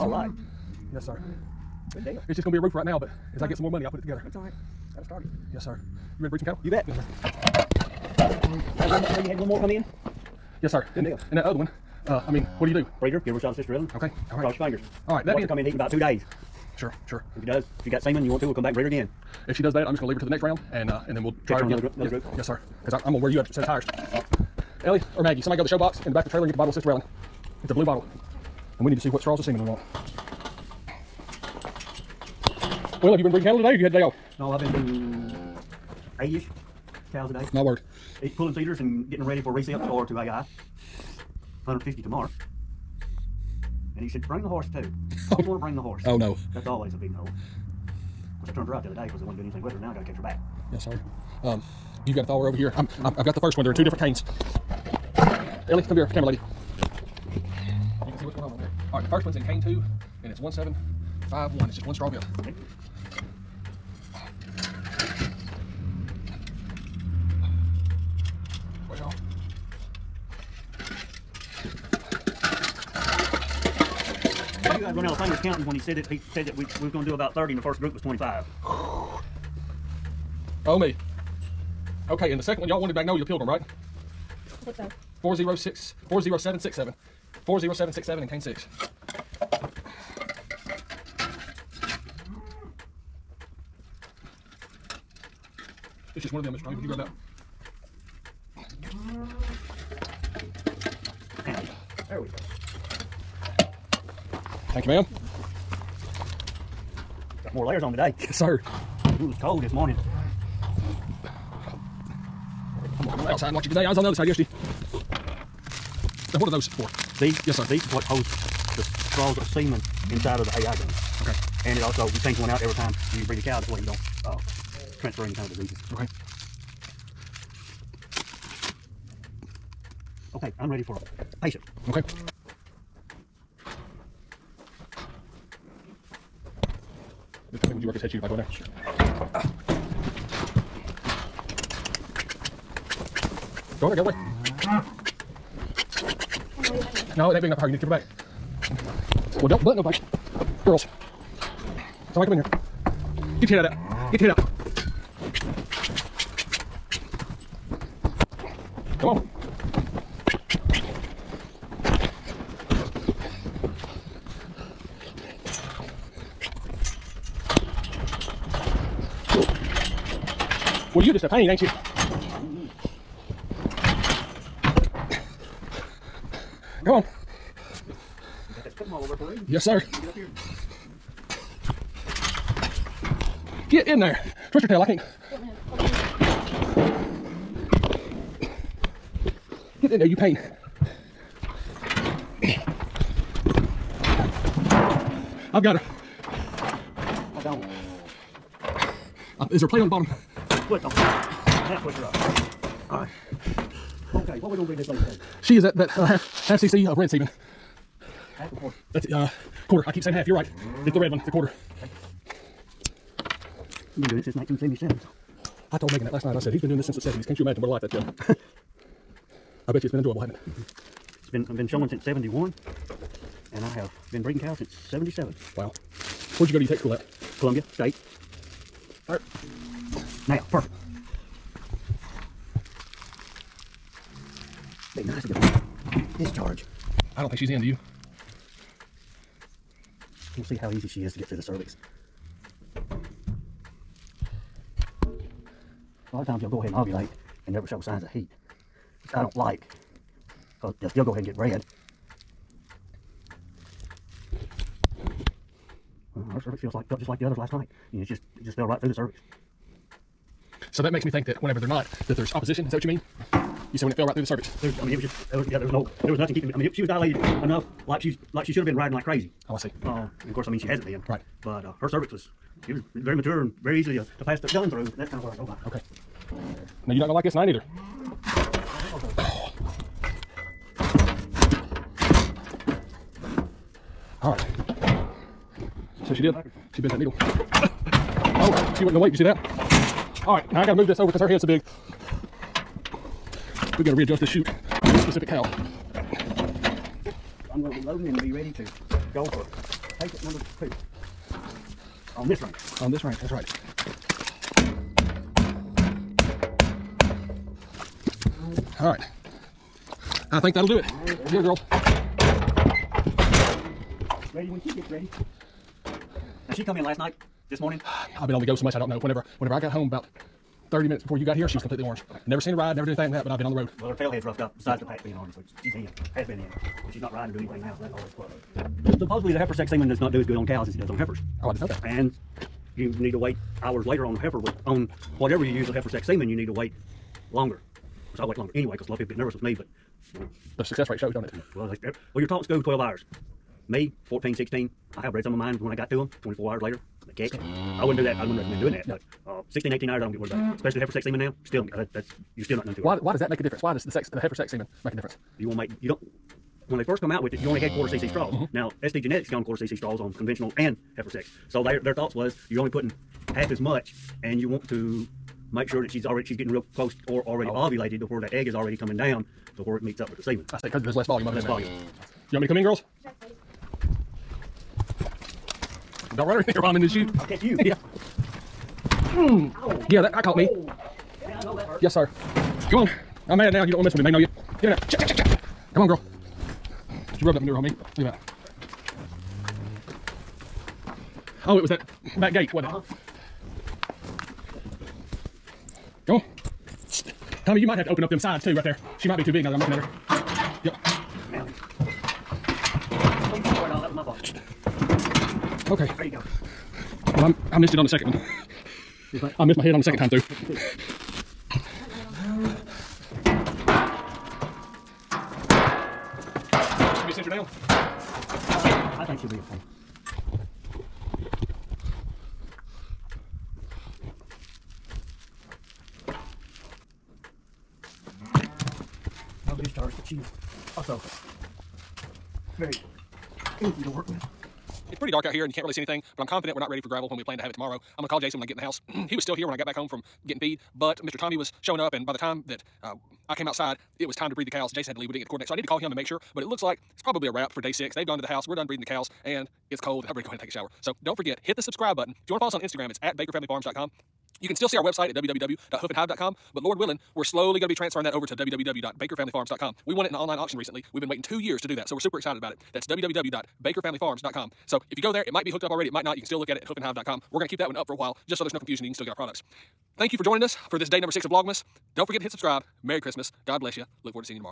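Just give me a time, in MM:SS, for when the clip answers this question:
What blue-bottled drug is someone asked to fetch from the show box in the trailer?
00:26.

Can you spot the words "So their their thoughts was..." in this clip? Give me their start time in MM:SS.
06:01.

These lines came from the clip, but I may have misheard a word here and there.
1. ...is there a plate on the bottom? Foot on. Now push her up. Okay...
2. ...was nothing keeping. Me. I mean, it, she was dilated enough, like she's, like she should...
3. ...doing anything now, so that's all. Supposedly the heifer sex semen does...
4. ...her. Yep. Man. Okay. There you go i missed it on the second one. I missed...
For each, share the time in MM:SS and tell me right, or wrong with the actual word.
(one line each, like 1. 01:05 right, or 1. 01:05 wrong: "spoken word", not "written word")
1. 03:19 right
2. 04:26 right
3. 05:27 right
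4. 06:39 right.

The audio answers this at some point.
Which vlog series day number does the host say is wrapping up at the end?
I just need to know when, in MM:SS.
07:27.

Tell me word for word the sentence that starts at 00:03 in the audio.
I get some more money, I'll put it together.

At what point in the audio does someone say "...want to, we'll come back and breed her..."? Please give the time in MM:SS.
00:18.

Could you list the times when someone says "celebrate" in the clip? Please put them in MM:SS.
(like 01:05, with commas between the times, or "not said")
not said.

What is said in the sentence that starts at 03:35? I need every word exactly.
I told Megan that last night.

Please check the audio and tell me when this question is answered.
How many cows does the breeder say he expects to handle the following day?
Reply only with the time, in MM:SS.
00:41.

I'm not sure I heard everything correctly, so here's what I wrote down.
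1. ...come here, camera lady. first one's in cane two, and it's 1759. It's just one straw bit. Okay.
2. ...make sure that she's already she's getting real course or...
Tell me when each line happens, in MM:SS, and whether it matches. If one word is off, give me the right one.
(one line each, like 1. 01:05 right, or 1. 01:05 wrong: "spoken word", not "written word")
1. 00:55 wrong: "1751", not "1759"
2. 06:05 wrong: "close", not "course".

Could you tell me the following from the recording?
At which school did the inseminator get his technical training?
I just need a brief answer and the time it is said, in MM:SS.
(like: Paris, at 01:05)
Columbia State, at 03:47.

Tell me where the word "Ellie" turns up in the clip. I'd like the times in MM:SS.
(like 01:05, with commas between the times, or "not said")
00:24, 00:55.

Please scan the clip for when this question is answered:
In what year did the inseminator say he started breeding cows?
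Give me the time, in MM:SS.
03:44.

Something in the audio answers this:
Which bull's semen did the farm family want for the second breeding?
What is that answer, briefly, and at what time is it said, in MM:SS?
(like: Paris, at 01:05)
Magnolia the Pilgrim, at 01:22.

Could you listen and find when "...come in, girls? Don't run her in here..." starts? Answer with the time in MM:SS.
06:12.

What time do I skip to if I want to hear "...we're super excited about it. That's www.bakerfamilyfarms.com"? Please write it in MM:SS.
07:41.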